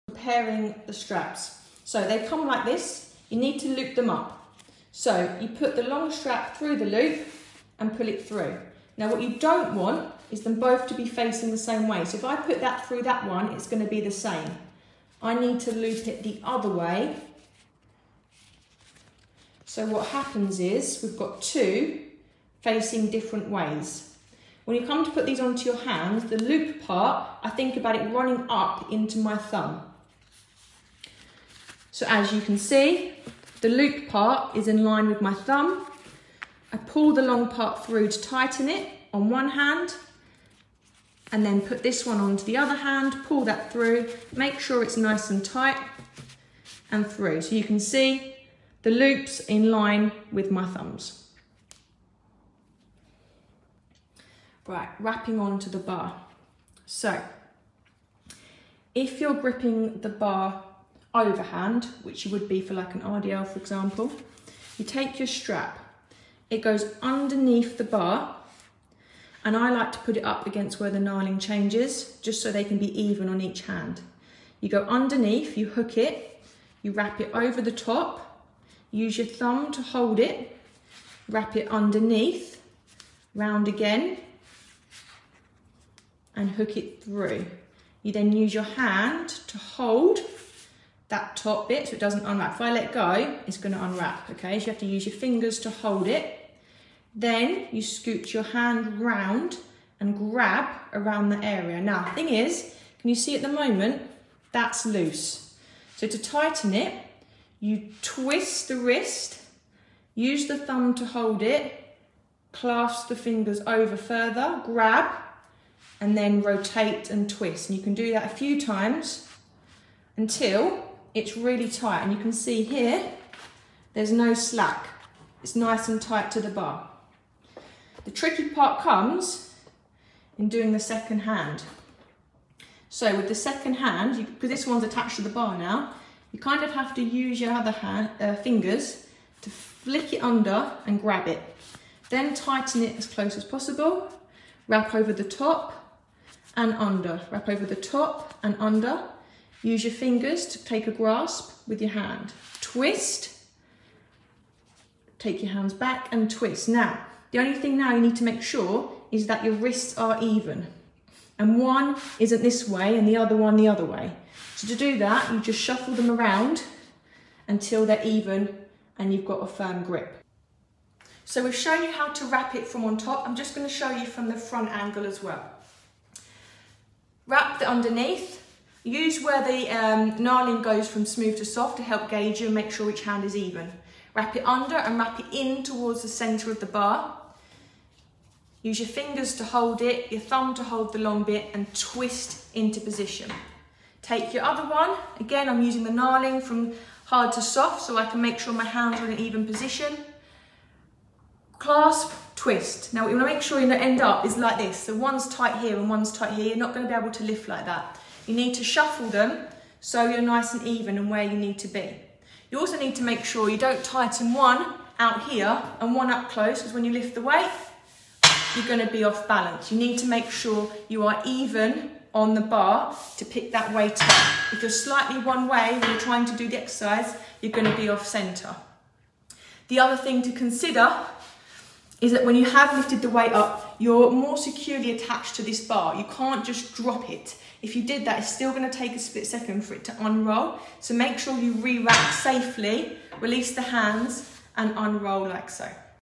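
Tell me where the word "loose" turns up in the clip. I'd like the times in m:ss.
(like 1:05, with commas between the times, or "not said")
1:44.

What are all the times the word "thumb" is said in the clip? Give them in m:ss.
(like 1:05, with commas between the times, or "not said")
0:29, 0:35, 0:50, 1:19, 1:50, 3:10.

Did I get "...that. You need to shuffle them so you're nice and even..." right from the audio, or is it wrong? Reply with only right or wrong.
right.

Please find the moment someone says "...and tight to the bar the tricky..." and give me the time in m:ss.
2:05.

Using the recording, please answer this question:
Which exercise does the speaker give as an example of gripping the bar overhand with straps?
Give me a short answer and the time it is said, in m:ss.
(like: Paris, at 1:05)
RDL, at 1:03.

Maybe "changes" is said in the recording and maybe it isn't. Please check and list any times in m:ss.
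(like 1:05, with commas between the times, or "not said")
1:11.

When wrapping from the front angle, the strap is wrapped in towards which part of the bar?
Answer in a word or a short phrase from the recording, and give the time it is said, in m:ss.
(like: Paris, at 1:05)
centre of the bar, at 3:06.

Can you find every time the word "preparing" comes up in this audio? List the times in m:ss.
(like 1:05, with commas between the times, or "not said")
0:00.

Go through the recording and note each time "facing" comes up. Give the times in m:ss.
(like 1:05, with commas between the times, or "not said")
0:11, 0:22.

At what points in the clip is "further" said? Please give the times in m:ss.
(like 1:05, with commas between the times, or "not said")
1:53.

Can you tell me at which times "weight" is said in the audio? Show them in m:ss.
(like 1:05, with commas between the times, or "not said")
3:37, 3:43, 3:53.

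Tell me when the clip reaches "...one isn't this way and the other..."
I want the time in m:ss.
2:41.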